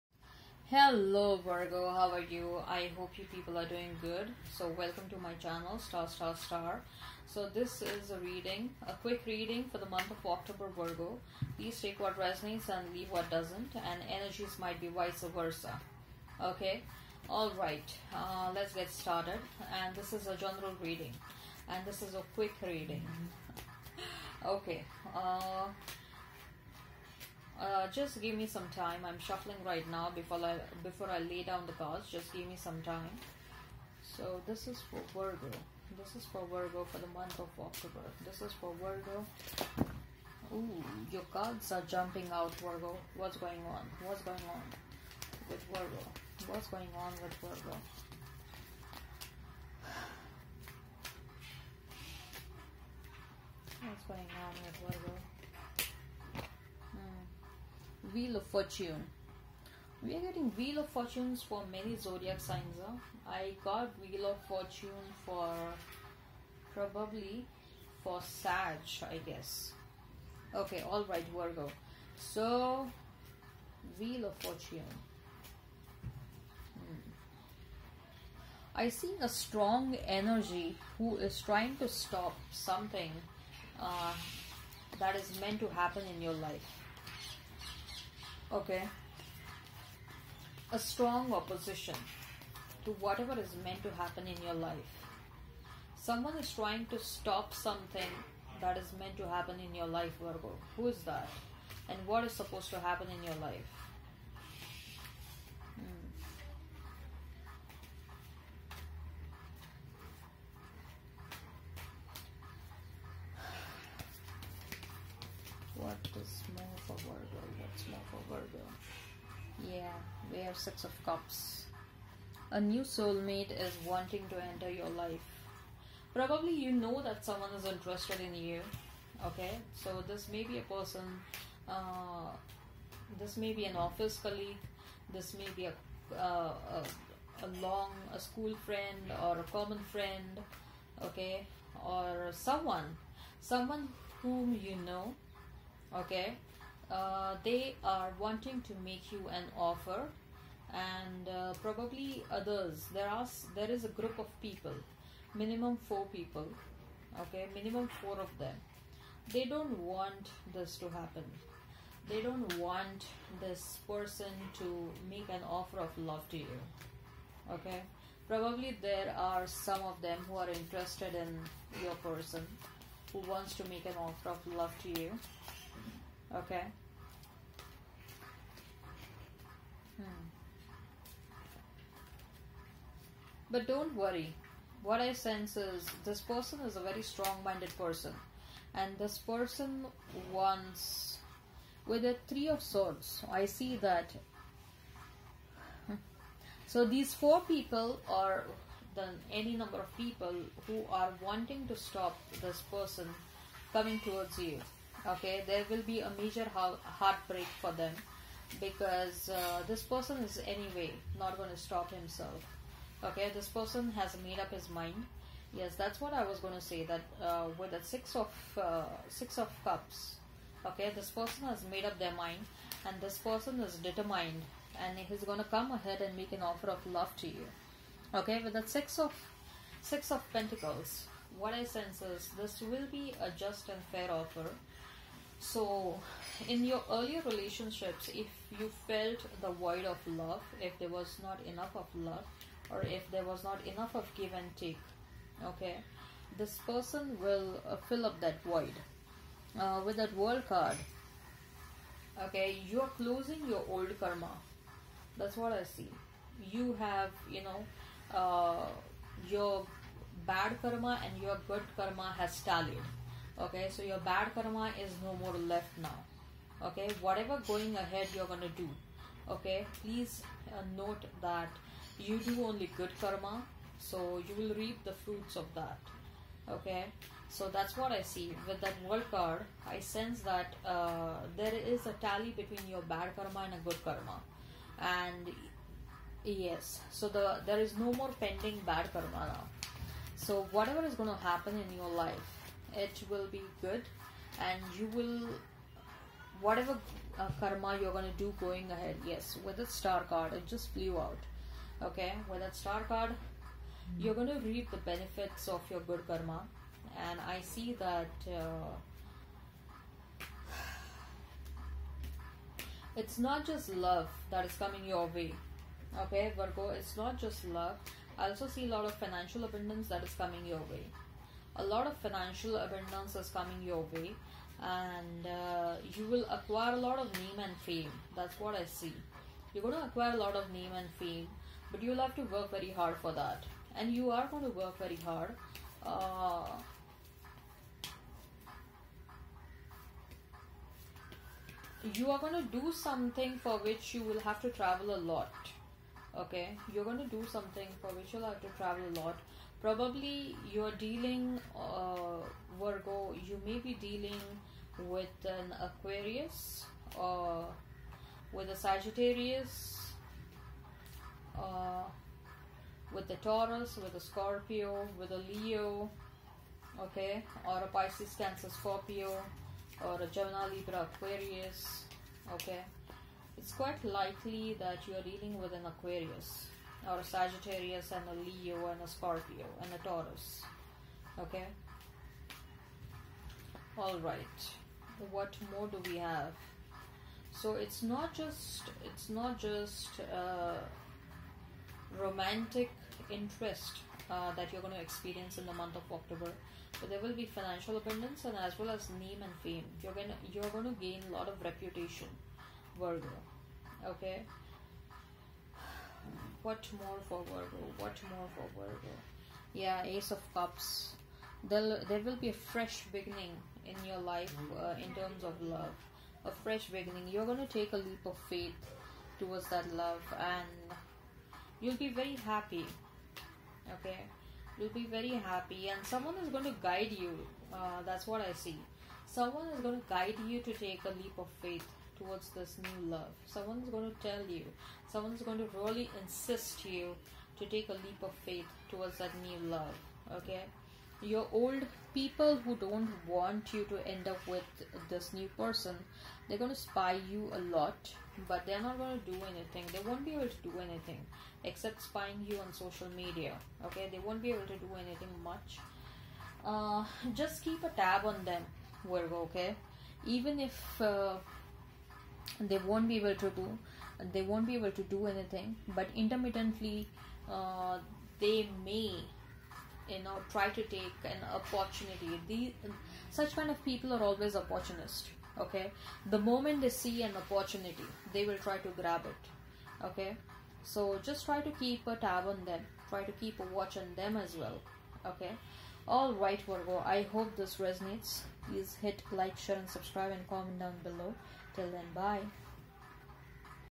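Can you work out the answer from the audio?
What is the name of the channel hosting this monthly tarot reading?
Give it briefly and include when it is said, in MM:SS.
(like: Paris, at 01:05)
Staar Staar Staar, at 00:05.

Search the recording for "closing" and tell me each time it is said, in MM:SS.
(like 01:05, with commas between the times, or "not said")
04:12.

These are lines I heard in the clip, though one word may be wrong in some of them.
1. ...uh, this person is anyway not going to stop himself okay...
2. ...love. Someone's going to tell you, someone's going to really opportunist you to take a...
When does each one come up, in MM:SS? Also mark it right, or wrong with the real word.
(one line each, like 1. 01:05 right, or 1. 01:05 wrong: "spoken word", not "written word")
1. 03:29 right
2. 07:12 wrong: "insist", not "opportunist".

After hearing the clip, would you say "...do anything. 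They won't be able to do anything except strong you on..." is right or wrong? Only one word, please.
wrong.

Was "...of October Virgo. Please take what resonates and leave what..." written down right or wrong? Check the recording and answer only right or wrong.
right.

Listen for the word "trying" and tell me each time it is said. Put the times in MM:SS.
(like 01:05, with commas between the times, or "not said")
01:21, 01:36.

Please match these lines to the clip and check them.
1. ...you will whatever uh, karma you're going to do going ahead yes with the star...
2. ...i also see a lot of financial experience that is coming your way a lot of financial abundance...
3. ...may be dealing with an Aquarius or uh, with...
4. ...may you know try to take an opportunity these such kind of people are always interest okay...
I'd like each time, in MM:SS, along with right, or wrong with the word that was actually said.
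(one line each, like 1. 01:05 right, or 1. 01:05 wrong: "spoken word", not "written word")
1. 04:54 right
2. 05:18 wrong: "abundance", not "experience"
3. 05:53 right
4. 07:48 wrong: "opportunist", not "interest".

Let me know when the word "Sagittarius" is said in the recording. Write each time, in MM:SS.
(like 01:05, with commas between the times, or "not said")
05:58, 06:17.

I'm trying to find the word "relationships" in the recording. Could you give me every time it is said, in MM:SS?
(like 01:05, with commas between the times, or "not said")
03:57.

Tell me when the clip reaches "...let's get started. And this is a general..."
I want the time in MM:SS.
00:18.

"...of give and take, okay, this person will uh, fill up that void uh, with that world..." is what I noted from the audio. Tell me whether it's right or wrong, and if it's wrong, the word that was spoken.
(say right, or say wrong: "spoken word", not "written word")
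right.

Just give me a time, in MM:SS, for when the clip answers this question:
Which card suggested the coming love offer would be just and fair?
03:49.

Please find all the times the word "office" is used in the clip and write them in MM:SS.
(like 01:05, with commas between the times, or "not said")
02:13.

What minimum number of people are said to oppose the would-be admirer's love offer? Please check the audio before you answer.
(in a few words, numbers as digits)
4.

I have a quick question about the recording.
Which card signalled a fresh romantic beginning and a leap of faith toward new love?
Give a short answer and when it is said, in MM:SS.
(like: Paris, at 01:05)
Ace of Cups, at 06:49.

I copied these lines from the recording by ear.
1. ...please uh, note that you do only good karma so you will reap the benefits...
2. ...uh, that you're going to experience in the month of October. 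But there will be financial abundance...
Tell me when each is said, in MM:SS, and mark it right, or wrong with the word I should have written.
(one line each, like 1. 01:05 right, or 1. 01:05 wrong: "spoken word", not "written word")
1. 04:29 wrong: "fruits", not "benefits"
2. 06:34 right.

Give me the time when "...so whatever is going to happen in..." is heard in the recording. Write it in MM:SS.
04:50.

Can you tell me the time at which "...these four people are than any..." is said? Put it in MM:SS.
03:16.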